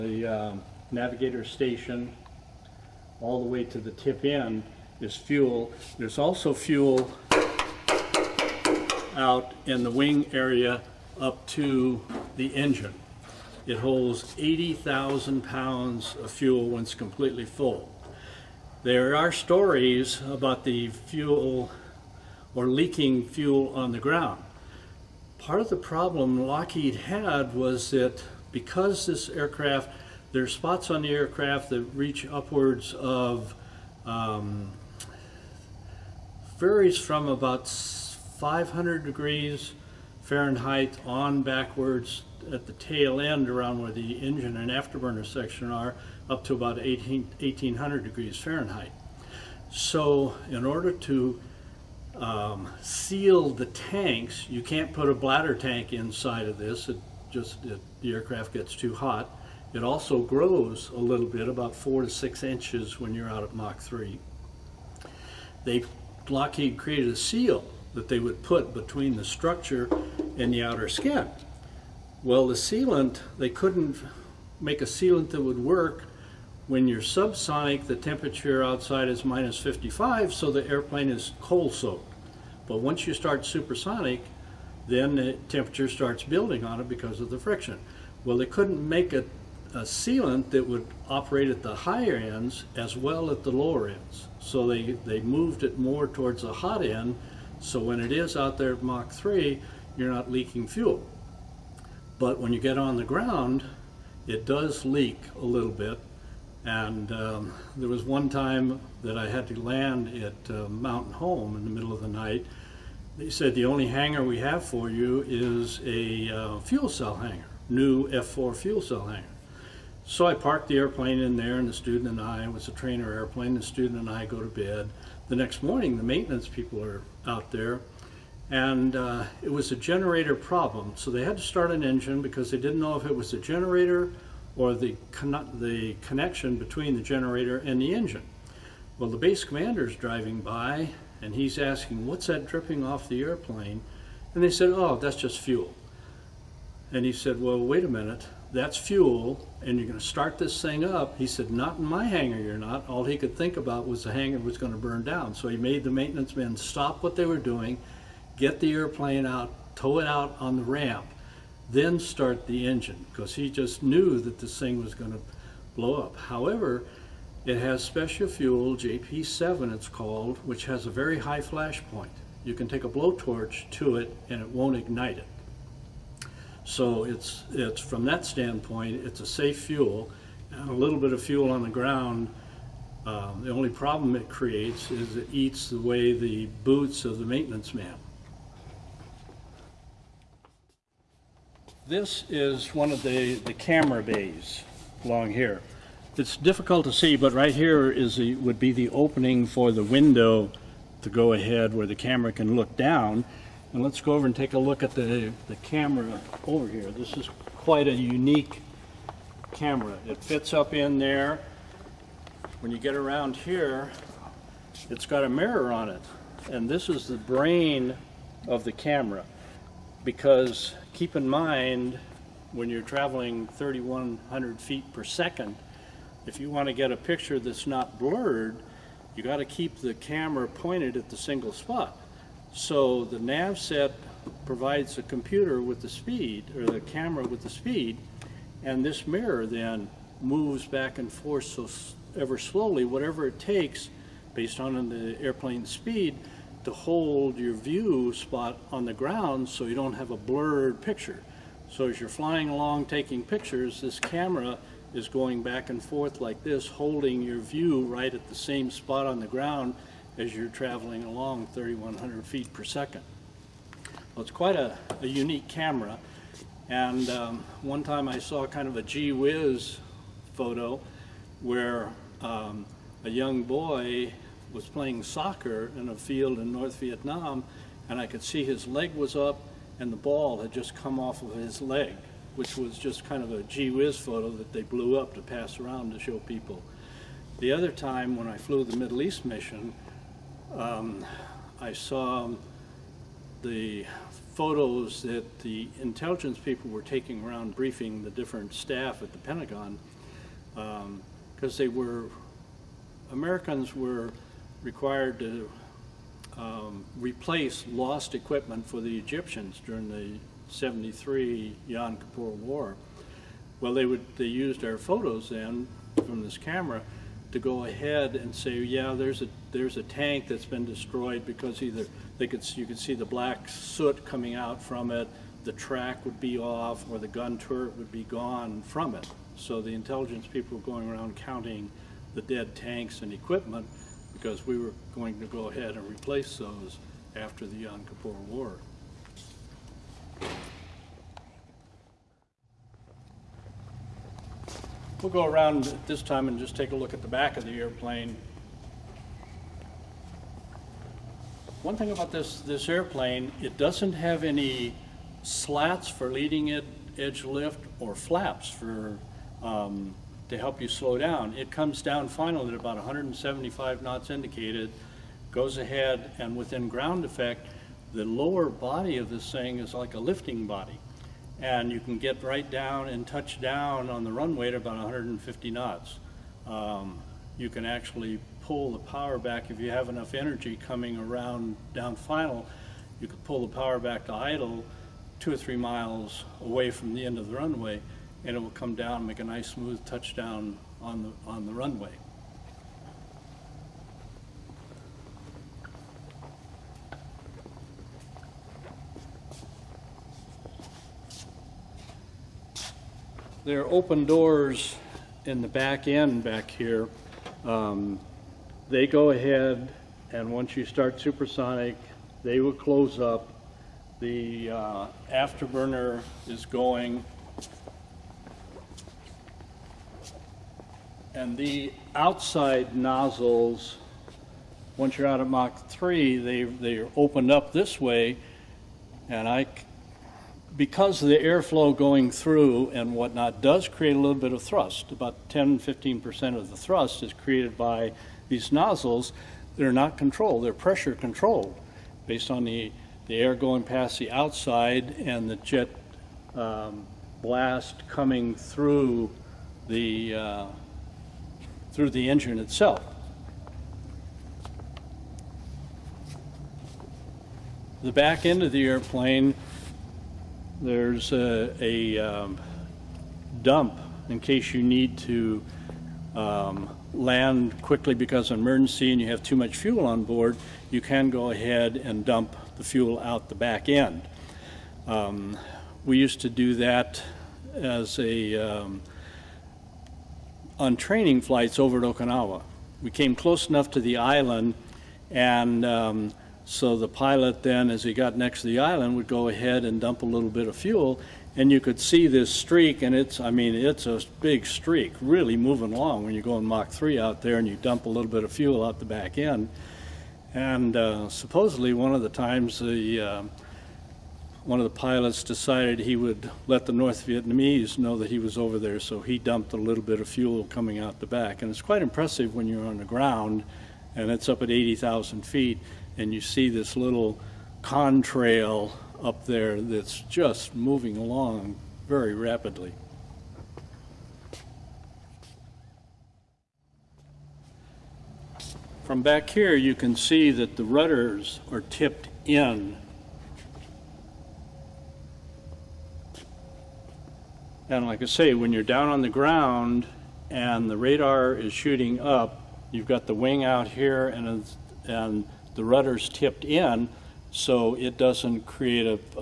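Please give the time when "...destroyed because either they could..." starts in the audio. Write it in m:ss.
5:20.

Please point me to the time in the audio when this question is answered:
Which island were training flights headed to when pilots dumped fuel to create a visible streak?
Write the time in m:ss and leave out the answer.
8:01.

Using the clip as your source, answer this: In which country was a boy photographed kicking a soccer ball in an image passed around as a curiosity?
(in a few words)
North Vietnam.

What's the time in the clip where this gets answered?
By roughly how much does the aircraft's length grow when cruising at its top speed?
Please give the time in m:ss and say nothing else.
1:01.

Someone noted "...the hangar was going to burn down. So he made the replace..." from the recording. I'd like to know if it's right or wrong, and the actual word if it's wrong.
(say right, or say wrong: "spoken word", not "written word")
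wrong: "maintenance", not "replace".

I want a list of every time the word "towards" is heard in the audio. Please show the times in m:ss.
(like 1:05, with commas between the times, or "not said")
1:36.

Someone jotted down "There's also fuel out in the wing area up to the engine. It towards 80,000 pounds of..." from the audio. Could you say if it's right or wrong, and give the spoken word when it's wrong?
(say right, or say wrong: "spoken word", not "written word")
wrong: "holds", not "towards".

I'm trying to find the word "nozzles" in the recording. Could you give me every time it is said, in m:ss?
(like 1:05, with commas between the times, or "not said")
7:02, 7:18.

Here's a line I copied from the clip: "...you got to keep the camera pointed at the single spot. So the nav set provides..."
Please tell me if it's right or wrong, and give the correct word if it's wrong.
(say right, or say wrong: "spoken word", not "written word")
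right.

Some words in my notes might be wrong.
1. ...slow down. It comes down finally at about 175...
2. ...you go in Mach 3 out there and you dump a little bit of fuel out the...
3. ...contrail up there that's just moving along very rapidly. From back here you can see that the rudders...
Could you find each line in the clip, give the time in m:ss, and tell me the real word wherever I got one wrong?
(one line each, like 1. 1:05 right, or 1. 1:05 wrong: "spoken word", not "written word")
1. 6:00 right
2. 8:16 right
3. 8:37 right.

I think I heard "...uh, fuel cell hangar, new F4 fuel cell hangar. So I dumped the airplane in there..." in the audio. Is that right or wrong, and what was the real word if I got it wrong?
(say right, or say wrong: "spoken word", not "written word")
wrong: "parked", not "dumped".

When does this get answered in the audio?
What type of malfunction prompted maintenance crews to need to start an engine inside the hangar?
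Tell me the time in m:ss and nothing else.
2:09.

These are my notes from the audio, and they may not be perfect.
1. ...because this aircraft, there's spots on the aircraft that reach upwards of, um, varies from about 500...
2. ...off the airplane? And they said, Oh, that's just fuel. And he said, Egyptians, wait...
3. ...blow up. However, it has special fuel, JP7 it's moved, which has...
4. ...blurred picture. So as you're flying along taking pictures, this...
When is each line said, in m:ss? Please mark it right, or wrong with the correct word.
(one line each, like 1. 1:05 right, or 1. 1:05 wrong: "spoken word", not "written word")
1. 0:28 right
2. 2:22 wrong: "Well", not "Egyptians"
3. 2:45 wrong: "called", not "moved"
4. 4:10 right.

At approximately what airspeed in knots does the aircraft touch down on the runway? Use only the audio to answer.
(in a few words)
150 knots.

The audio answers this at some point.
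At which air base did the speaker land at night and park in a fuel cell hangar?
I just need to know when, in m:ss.
1:50.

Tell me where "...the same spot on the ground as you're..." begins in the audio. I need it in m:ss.
4:18.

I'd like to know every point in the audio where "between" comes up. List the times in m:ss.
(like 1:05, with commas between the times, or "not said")
1:08, 2:16.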